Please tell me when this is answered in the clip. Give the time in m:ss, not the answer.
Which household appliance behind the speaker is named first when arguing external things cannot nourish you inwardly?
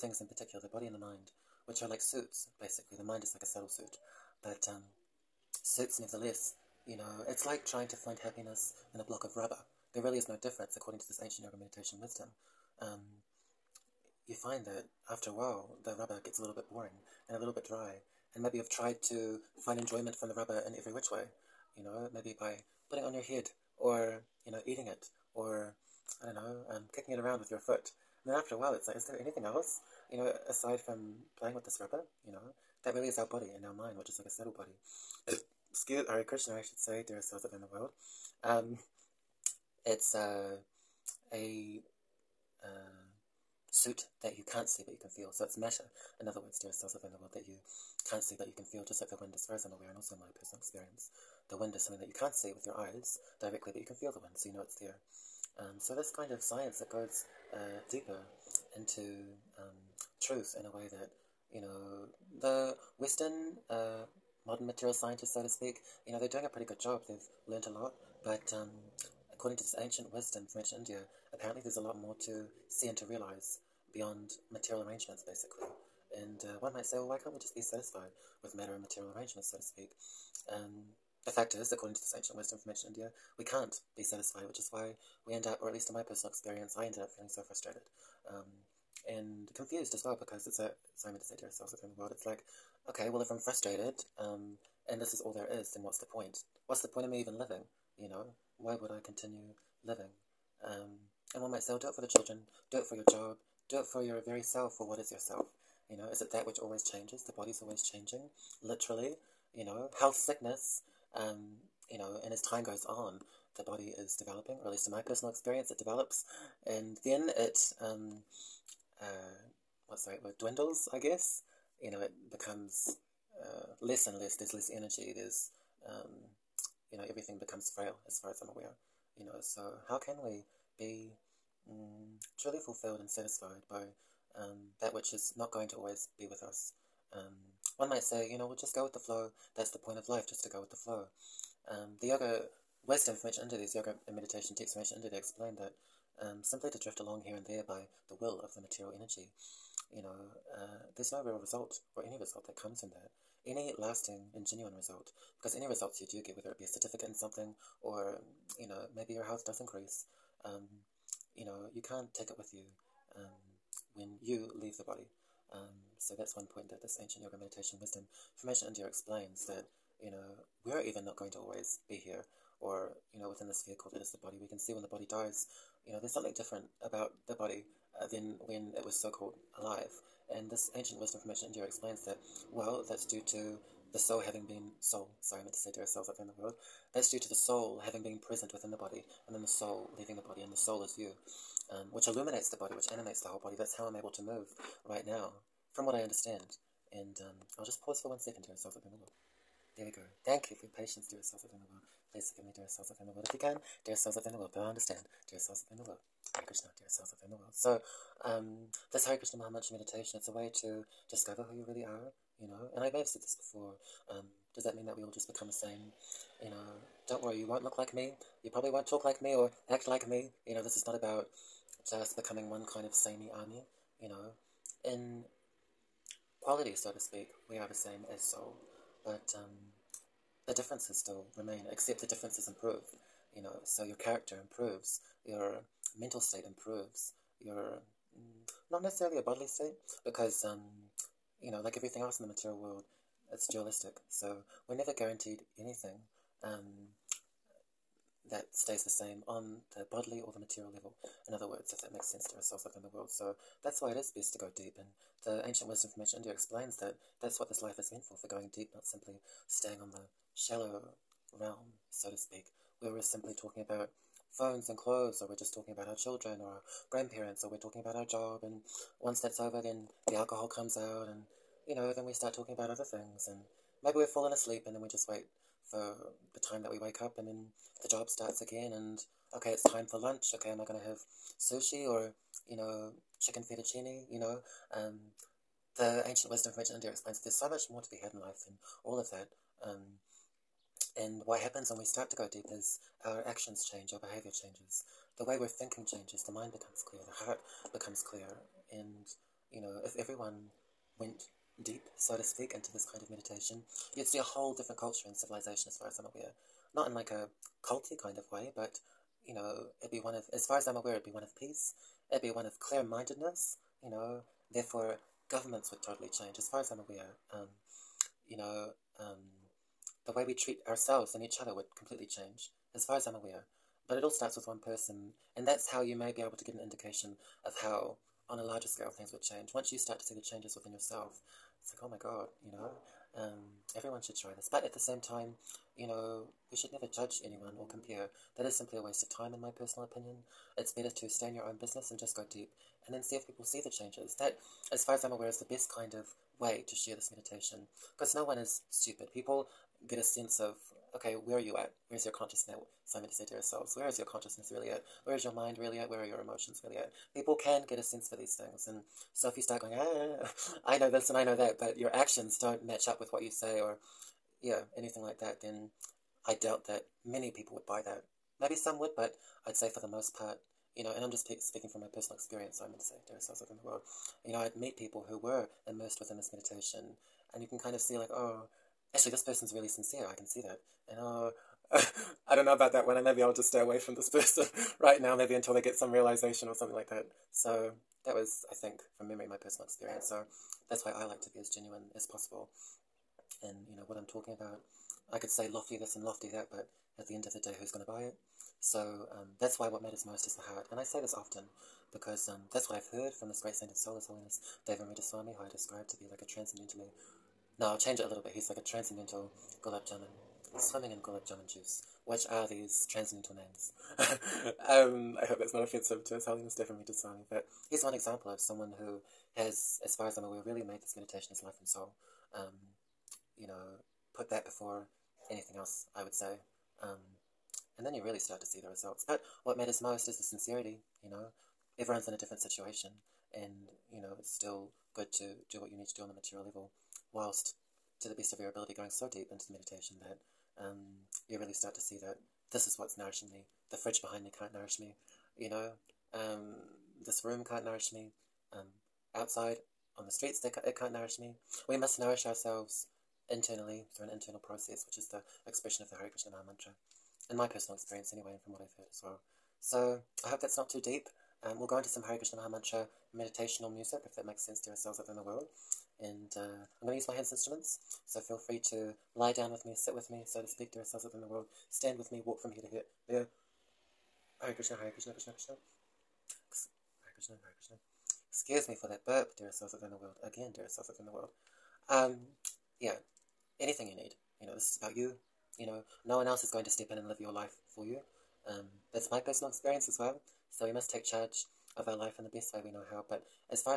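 7:23.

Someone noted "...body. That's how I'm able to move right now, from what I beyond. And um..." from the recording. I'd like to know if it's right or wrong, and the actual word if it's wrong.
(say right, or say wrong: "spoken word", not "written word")
wrong: "understand", not "beyond".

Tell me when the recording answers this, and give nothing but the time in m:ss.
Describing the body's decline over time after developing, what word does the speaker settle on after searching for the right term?
2:00.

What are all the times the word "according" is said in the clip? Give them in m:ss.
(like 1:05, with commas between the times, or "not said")
0:10, 1:09, 1:21.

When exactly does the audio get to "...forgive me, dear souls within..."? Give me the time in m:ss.
3:22.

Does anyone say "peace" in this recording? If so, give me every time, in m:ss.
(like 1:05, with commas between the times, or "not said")
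5:11.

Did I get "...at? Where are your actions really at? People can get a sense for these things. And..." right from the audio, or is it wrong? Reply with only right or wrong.
wrong.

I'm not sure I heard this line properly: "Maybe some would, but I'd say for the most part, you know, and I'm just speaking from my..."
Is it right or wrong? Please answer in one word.
right.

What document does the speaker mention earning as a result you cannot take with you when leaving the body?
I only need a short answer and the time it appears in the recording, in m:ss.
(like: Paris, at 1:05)
a certificate, at 2:36.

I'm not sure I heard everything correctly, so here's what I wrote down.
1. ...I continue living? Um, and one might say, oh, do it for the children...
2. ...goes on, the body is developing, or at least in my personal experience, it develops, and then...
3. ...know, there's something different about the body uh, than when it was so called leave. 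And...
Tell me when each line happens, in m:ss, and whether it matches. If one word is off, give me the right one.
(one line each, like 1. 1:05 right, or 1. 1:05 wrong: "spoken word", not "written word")
1. 1:38 right
2. 1:52 right
3. 2:55 wrong: "alive", not "leave".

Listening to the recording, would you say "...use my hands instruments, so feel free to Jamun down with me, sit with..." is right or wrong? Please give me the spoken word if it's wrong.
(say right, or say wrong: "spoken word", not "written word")
wrong: "Lie", not "Jamun".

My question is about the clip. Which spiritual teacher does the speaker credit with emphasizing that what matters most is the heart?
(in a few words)
Devamrita Swami.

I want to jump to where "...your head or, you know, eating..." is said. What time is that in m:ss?
0:23.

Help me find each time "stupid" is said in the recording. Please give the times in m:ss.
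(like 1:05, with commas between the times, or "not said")
5:48.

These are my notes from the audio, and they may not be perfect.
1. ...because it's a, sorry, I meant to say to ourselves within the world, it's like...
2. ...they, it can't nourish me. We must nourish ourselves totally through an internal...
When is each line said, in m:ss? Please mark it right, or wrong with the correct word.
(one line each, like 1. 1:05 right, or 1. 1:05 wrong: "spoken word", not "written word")
1. 1:30 right
2. 7:30 wrong: "internally", not "totally".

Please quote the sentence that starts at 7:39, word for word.
So, I hope that's not too deep.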